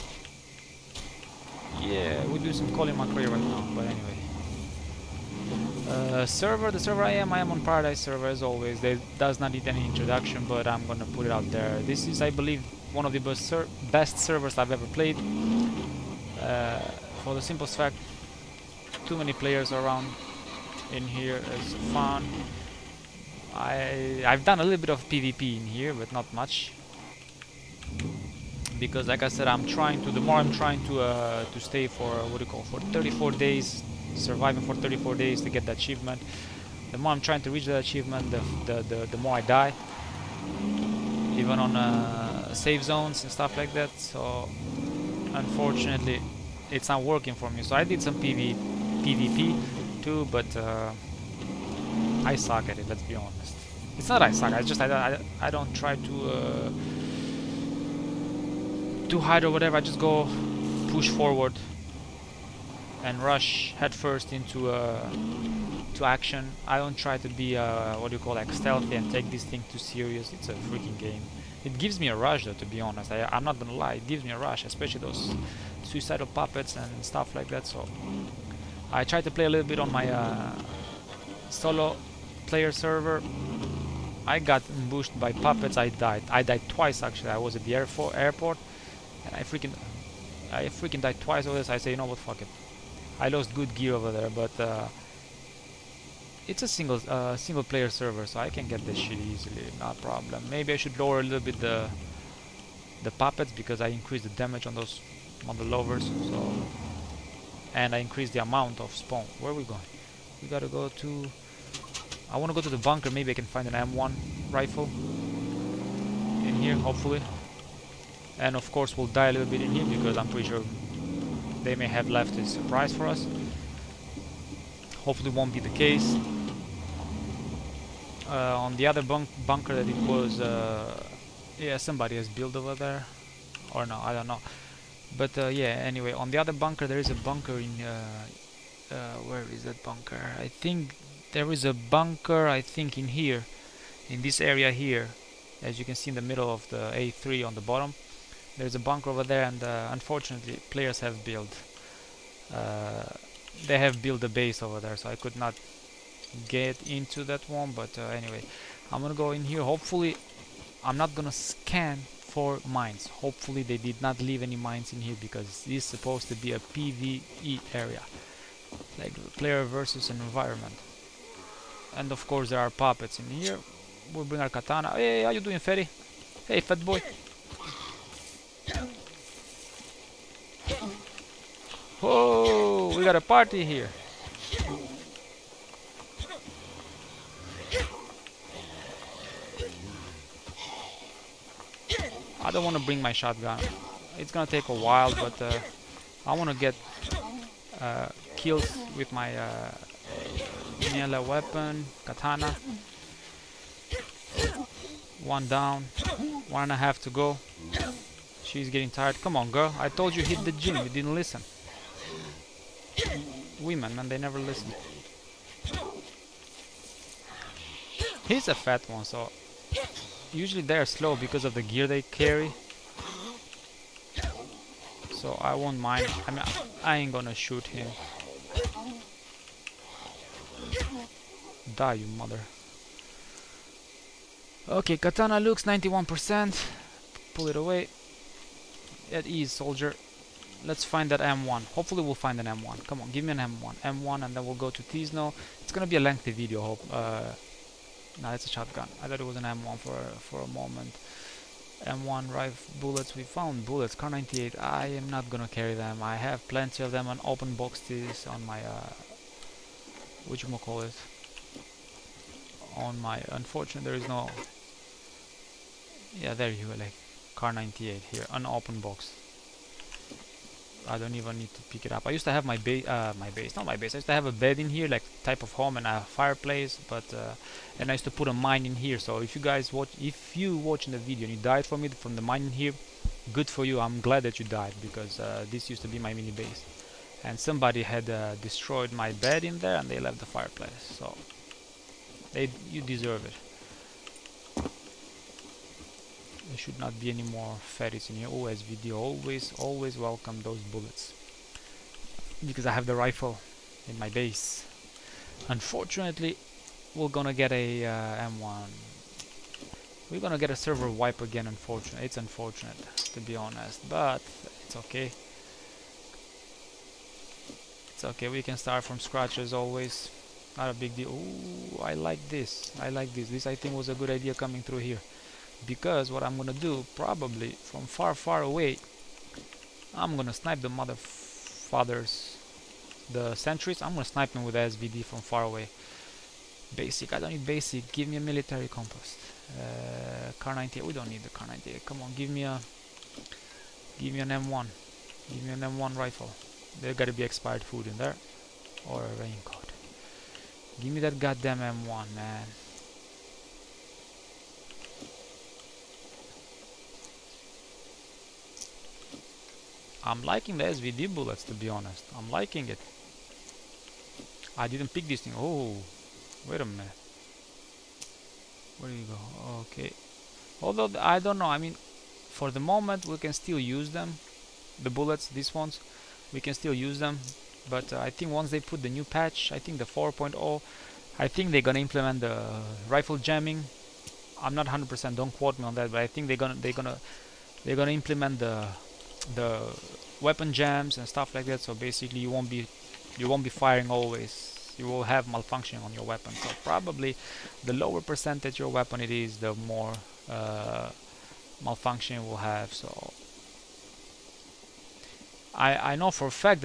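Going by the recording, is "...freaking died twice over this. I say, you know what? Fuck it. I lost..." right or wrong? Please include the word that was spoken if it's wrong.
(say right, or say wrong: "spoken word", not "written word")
right.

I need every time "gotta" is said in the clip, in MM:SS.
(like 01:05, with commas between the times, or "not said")
01:50, 05:46.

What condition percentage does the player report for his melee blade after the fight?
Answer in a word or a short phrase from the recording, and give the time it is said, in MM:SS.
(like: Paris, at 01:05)
91%, at 03:55.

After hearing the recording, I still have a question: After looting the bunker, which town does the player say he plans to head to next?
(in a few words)
Tisno.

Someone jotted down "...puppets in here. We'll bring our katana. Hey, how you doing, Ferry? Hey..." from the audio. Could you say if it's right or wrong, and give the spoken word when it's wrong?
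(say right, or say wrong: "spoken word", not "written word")
right.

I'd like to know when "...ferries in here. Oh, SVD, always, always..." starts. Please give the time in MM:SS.
04:57.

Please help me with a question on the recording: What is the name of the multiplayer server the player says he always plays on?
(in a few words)
Paradise.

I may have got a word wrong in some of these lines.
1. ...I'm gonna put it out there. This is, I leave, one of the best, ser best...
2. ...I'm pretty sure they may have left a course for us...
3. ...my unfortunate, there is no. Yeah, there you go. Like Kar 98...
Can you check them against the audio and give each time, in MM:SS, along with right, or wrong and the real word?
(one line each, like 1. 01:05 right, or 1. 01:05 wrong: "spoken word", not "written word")
1. 00:10 wrong: "believe", not "leave"
2. 02:00 wrong: "surprise", not "course"
3. 04:22 right.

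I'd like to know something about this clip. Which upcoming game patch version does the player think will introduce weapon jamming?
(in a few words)
4.0.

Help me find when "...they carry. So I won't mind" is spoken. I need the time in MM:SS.
03:41.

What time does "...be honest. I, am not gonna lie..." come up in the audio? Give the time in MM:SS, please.
01:12.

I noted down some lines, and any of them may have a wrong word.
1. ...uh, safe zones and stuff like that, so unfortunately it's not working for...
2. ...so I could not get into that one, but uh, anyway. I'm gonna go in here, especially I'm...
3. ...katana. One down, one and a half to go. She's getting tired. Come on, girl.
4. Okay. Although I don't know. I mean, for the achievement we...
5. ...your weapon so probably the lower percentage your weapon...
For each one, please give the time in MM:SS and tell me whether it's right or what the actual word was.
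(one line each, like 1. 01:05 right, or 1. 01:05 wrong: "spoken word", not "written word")
1. 00:41 right
2. 02:34 wrong: "hopefully", not "especially"
3. 03:22 right
4. 06:09 wrong: "moment", not "achievement"
5. 06:35 right.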